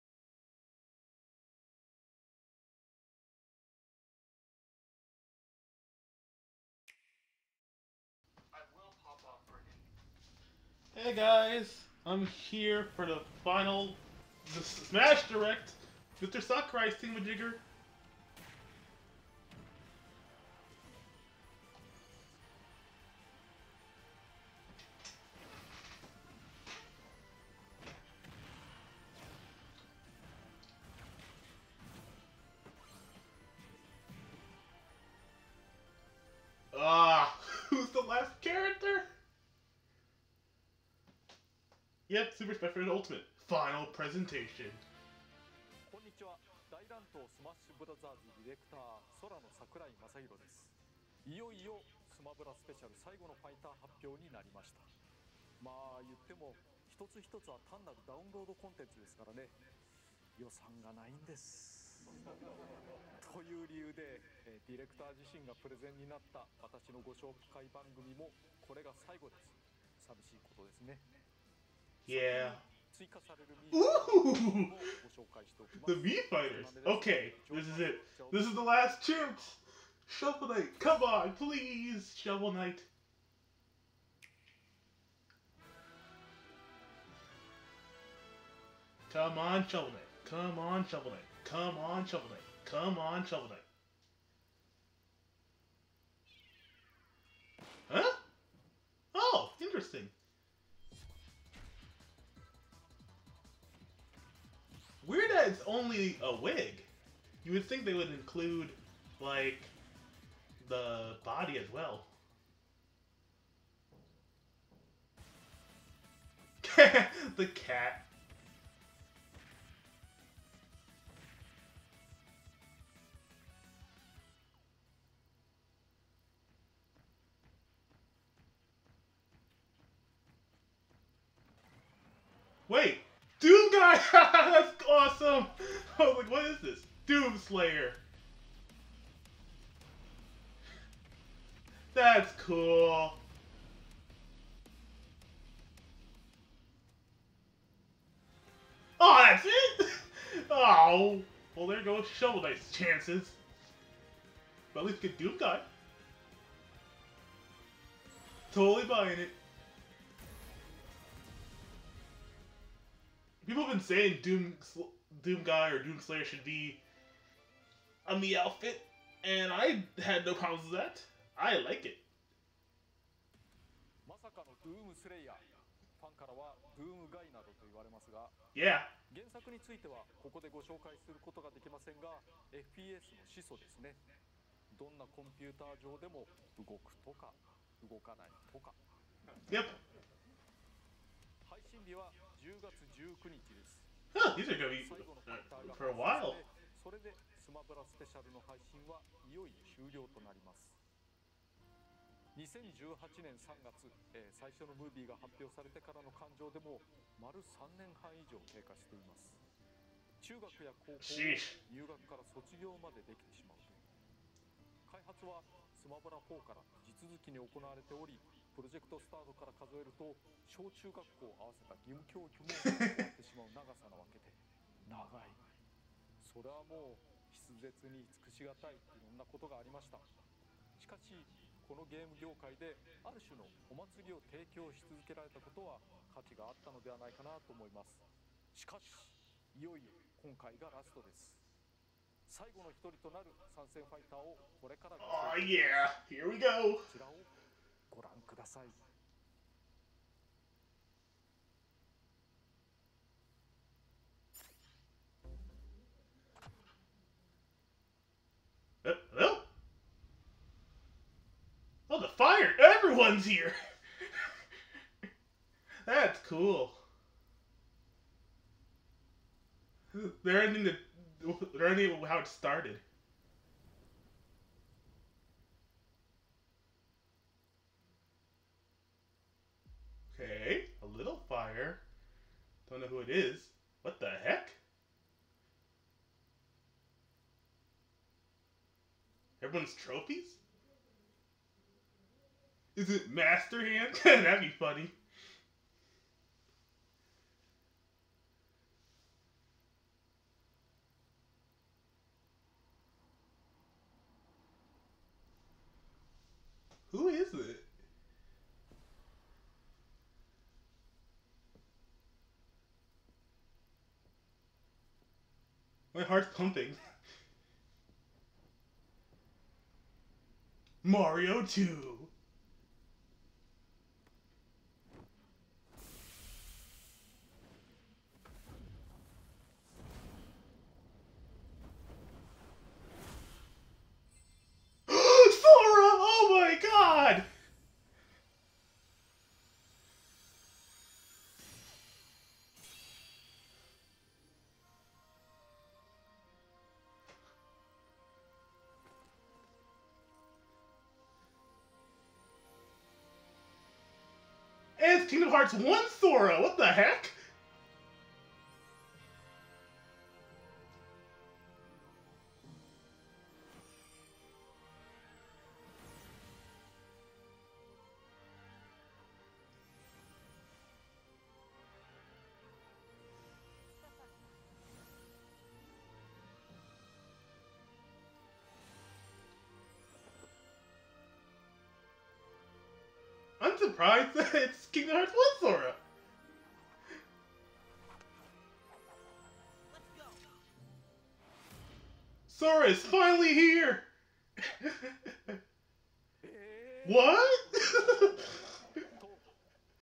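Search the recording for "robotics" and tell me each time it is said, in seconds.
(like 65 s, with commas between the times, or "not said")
not said.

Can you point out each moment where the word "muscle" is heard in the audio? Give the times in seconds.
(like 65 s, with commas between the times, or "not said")
not said.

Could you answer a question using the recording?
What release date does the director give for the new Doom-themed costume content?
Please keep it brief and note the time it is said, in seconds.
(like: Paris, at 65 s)
October 19, at 192 s.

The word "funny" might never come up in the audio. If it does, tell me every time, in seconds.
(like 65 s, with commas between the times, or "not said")
294 s.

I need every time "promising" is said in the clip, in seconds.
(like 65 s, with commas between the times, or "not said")
not said.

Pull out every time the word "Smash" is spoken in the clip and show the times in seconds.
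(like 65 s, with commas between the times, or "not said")
14 s, 42 s.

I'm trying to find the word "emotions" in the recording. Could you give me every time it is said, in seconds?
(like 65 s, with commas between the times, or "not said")
not said.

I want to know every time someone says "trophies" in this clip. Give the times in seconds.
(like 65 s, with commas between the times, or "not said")
289 s.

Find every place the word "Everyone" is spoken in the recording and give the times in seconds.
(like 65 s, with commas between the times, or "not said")
262 s, 289 s.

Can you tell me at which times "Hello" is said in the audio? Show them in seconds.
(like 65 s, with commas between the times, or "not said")
259 s.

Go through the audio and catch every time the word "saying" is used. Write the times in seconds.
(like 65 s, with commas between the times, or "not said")
163 s.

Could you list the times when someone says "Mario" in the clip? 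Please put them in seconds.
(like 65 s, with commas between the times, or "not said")
320 s.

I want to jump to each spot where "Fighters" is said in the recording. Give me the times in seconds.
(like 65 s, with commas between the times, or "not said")
76 s.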